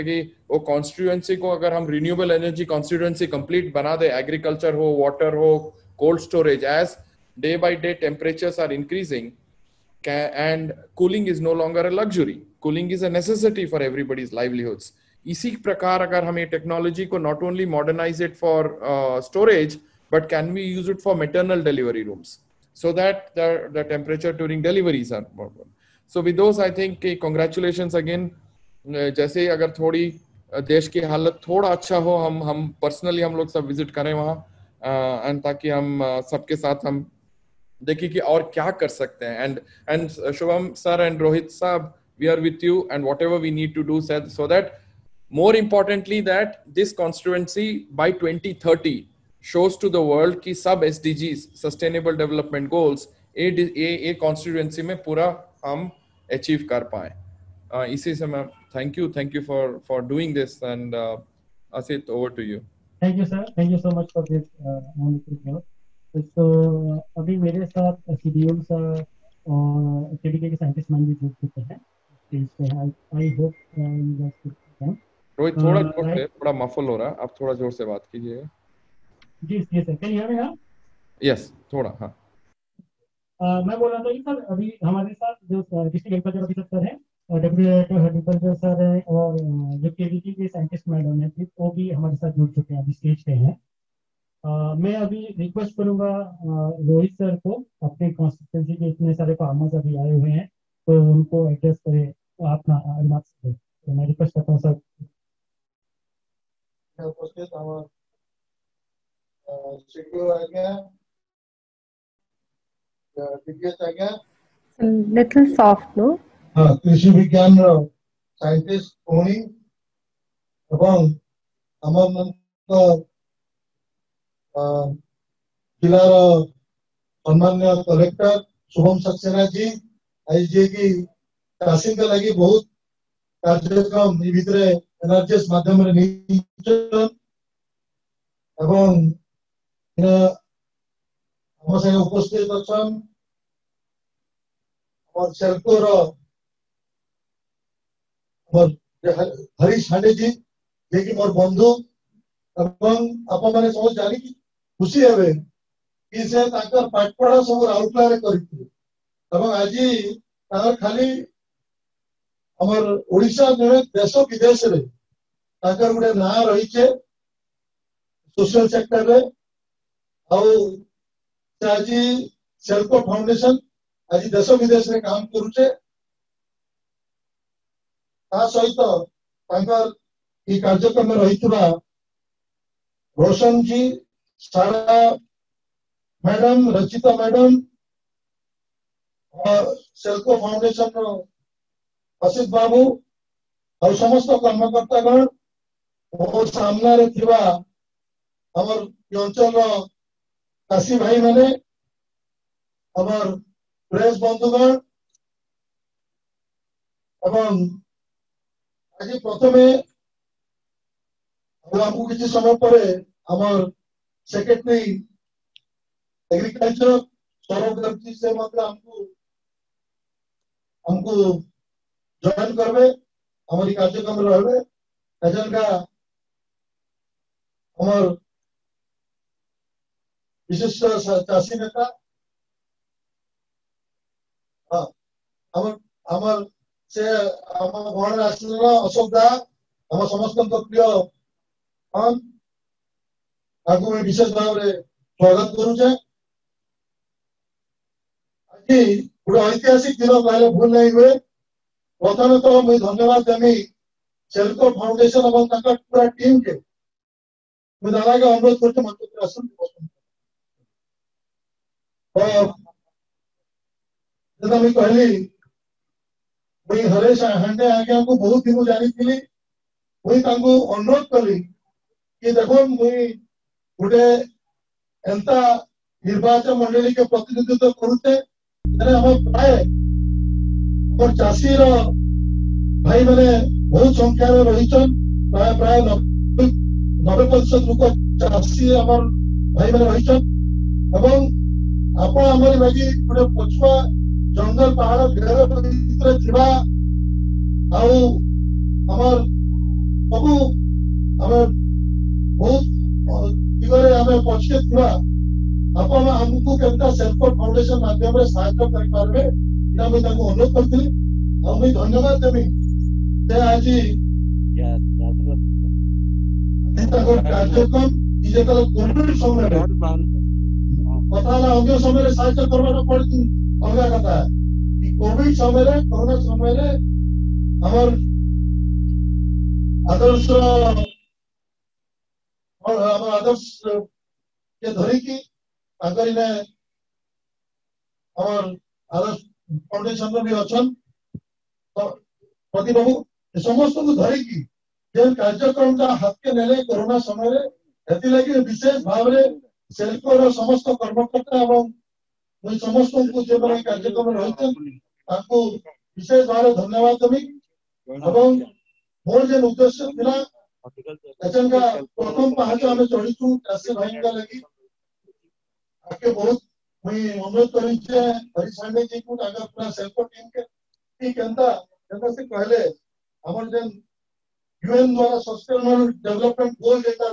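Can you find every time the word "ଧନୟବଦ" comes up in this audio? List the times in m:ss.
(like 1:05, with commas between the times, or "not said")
4:12, 5:11.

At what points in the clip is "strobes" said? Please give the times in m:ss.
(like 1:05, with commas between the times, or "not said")
not said.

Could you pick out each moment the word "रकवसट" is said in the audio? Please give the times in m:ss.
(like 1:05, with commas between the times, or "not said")
1:35, 1:44.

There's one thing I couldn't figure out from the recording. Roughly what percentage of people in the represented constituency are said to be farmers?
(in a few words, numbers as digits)
90%.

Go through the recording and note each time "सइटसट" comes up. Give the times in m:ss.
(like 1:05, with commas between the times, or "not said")
1:10, 1:30, 1:58.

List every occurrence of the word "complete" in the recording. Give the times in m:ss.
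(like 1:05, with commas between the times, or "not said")
0:03.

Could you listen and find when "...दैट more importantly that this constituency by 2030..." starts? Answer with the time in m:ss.
0:44.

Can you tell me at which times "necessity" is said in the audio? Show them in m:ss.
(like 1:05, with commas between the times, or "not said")
0:13.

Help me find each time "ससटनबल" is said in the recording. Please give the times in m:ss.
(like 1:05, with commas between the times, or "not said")
6:15.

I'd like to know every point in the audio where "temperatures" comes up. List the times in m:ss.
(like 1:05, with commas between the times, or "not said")
0:08, 0:23.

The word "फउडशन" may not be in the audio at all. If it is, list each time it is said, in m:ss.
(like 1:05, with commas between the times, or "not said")
2:53, 3:10.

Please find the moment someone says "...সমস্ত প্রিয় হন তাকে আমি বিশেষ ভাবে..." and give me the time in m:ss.
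4:00.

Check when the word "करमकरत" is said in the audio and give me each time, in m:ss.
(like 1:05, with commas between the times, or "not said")
3:14, 5:50.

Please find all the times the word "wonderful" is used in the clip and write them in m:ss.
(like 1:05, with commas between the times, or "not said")
1:05.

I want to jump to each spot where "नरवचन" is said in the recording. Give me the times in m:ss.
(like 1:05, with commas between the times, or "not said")
4:36.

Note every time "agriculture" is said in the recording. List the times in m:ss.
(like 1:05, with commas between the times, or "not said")
0:04.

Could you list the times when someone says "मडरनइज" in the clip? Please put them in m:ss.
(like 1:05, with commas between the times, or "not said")
0:17.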